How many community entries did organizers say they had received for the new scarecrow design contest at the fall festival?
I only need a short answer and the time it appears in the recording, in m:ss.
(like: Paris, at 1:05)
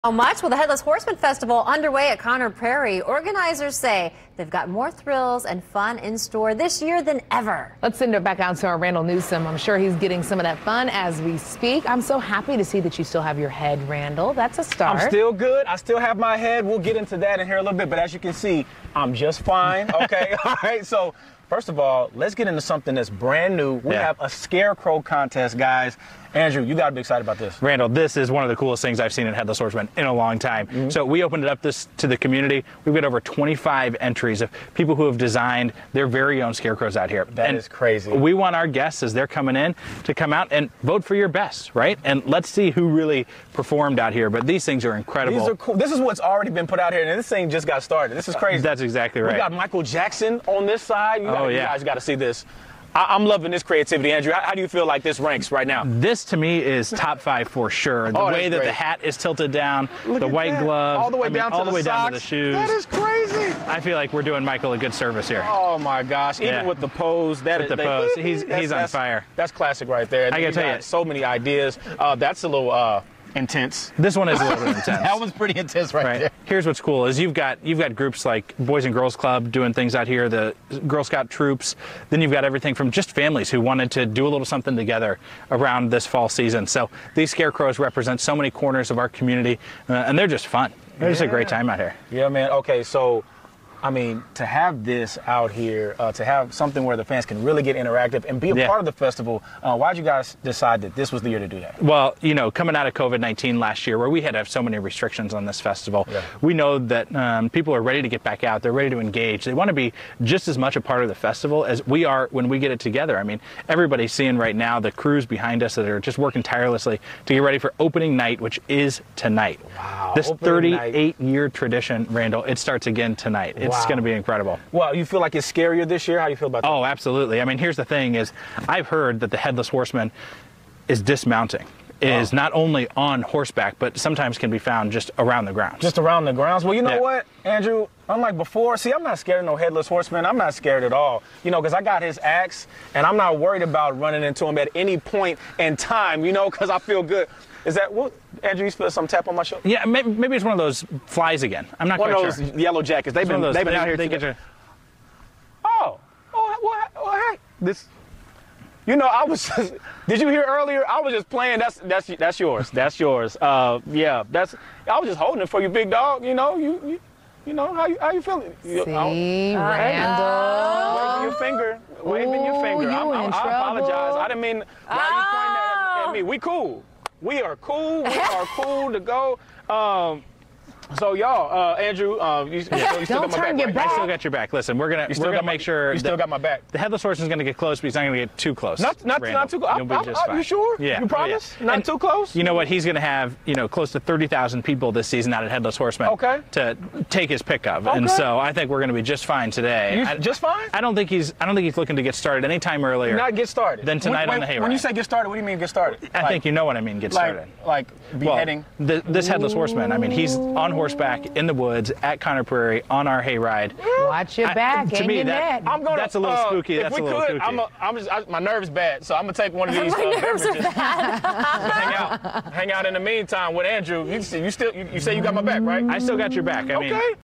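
25, at 0:33.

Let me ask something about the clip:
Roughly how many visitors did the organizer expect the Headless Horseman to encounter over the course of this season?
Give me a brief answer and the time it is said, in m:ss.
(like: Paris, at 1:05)
30,000, at 3:13.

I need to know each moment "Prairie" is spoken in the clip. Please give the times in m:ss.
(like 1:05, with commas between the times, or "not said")
0:02, 3:32.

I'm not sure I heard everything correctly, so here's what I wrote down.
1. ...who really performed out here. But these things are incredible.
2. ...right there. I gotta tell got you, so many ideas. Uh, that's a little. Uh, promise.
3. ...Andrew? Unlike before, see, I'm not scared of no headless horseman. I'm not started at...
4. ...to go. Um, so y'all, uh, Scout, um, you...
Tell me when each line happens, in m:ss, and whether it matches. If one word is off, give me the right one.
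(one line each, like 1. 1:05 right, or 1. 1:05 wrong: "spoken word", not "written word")
1. 0:42 right
2. 1:09 wrong: "intense", not "promise"
3. 2:17 wrong: "scared", not "started"
4. 2:58 wrong: "Andrew", not "Scout".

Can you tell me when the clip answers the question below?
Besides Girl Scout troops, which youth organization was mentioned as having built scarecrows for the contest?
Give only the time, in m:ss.
1:18.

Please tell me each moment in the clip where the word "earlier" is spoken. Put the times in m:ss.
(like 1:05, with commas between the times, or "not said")
2:40, 3:22.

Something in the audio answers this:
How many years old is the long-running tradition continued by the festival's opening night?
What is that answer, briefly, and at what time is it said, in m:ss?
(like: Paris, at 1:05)
38, at 2:00.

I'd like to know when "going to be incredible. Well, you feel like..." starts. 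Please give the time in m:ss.
2:03.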